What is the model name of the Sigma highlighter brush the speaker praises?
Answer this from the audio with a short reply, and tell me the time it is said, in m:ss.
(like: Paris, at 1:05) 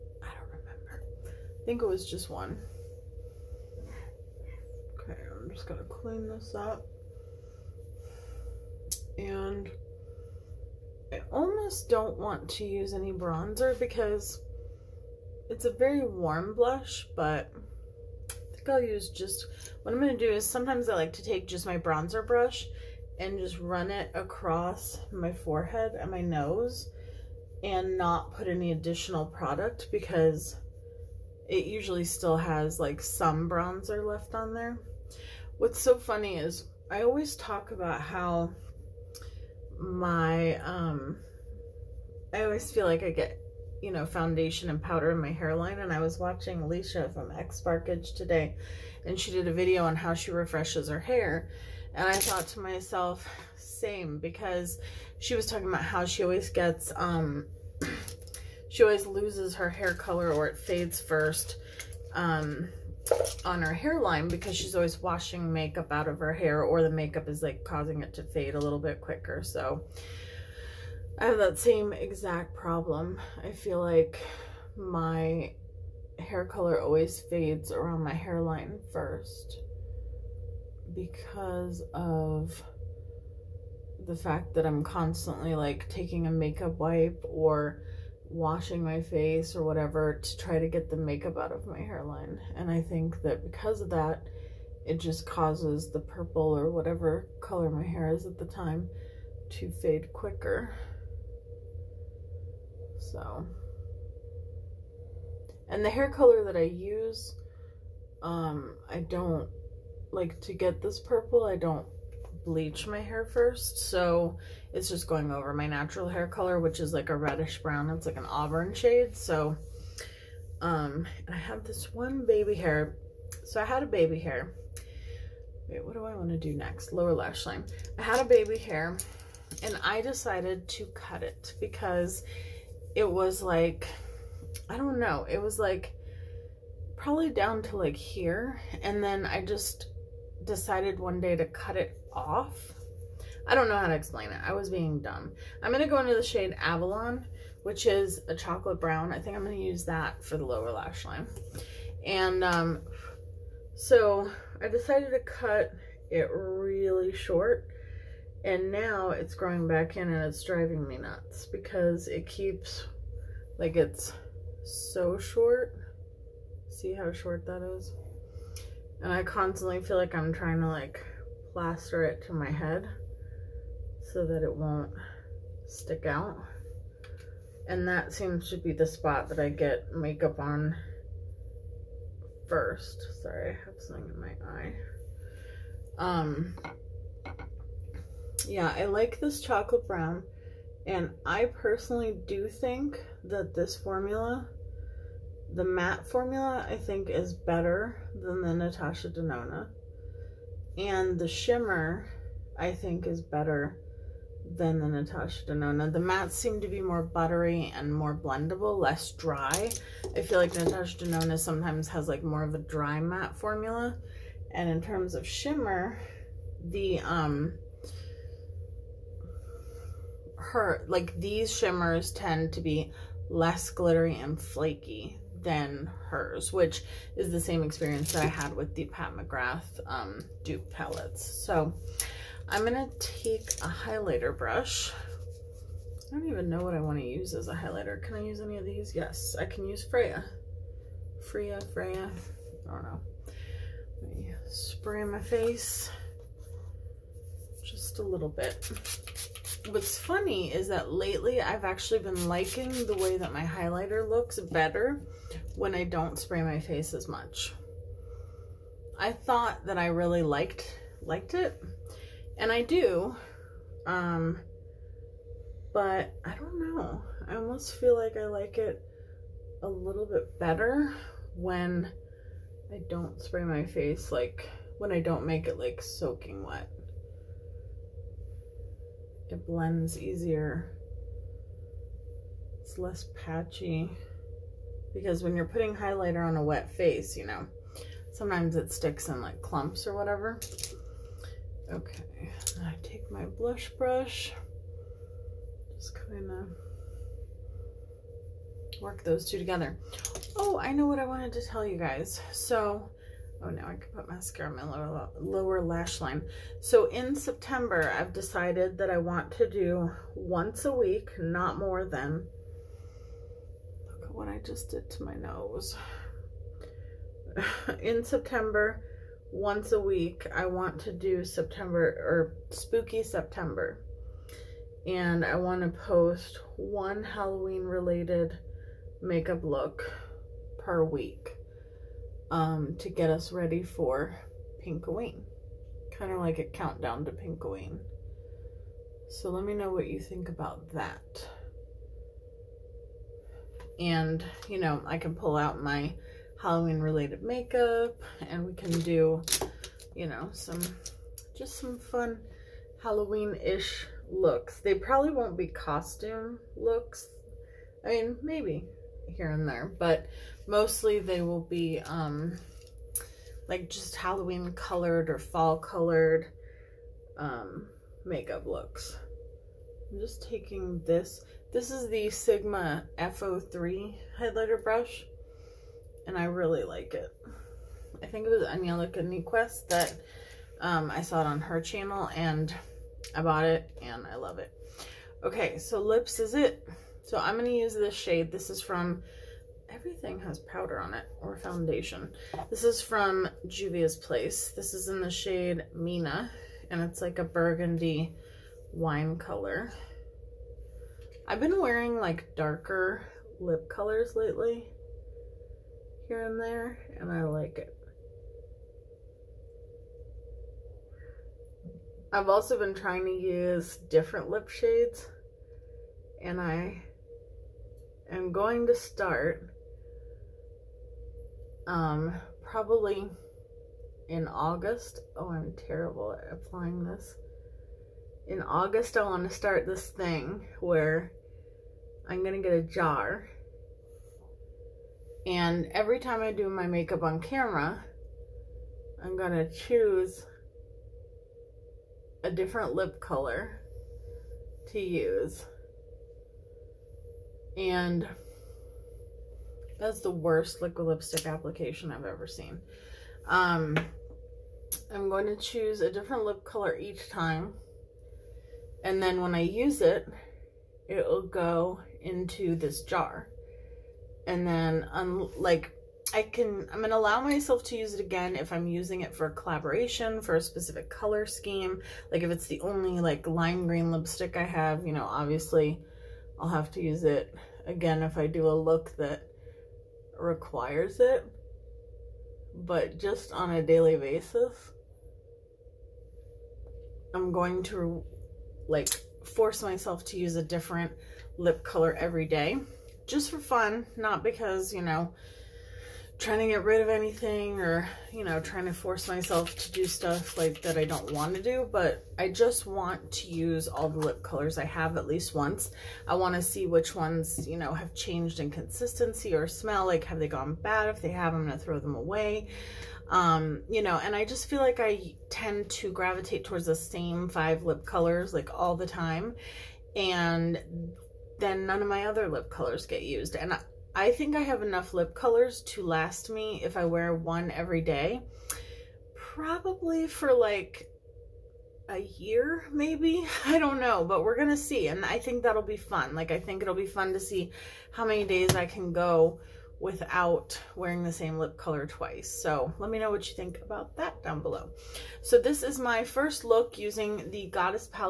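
F03, at 6:12.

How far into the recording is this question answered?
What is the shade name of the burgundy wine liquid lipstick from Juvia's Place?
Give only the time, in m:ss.
6:35.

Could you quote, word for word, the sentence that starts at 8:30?
If they have, I'm going to throw them away.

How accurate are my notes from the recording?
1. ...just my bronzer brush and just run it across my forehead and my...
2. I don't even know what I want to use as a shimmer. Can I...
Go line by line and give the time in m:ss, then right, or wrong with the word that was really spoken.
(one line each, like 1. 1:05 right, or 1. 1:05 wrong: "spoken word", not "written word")
1. 0:21 right
2. 3:56 wrong: "highlighter", not "shimmer".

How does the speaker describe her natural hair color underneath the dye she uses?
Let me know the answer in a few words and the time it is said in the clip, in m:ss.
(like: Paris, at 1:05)
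auburn, at 1:58.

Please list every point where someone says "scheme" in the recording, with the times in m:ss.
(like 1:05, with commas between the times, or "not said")
7:51.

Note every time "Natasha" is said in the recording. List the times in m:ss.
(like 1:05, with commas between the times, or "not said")
3:18, 3:24, 3:30.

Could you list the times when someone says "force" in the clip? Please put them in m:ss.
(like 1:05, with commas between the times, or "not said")
8:09, 8:18.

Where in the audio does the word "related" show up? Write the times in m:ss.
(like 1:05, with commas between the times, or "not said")
5:27, 5:46.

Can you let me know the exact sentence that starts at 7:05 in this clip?
Oh, I'm terrible at applying this.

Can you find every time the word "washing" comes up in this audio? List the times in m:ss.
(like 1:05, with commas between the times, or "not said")
1:05, 1:28.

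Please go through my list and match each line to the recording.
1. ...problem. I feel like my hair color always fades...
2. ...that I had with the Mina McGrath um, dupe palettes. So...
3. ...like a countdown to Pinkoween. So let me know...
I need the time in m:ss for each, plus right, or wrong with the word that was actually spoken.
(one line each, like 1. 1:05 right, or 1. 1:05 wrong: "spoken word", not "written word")
1. 1:12 right
2. 3:48 wrong: "Pat", not "Mina"
3. 5:36 right.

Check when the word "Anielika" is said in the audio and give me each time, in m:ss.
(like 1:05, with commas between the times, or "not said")
6:18.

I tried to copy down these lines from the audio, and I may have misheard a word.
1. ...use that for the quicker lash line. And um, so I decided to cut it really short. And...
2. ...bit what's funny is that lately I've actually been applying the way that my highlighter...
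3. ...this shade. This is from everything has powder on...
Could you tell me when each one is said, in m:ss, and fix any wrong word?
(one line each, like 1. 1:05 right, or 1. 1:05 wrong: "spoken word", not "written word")
1. 2:29 wrong: "lower", not "quicker"
2. 4:08 wrong: "liking", not "applying"
3. 6:27 right.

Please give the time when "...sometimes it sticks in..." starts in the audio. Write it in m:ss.
4:48.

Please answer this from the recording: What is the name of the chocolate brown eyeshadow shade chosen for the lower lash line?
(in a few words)
Avalon.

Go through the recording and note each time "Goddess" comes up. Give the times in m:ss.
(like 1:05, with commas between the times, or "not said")
9:07.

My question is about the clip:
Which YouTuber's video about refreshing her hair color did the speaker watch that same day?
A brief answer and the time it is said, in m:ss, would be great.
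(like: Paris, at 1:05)
Alicia, at 0:46.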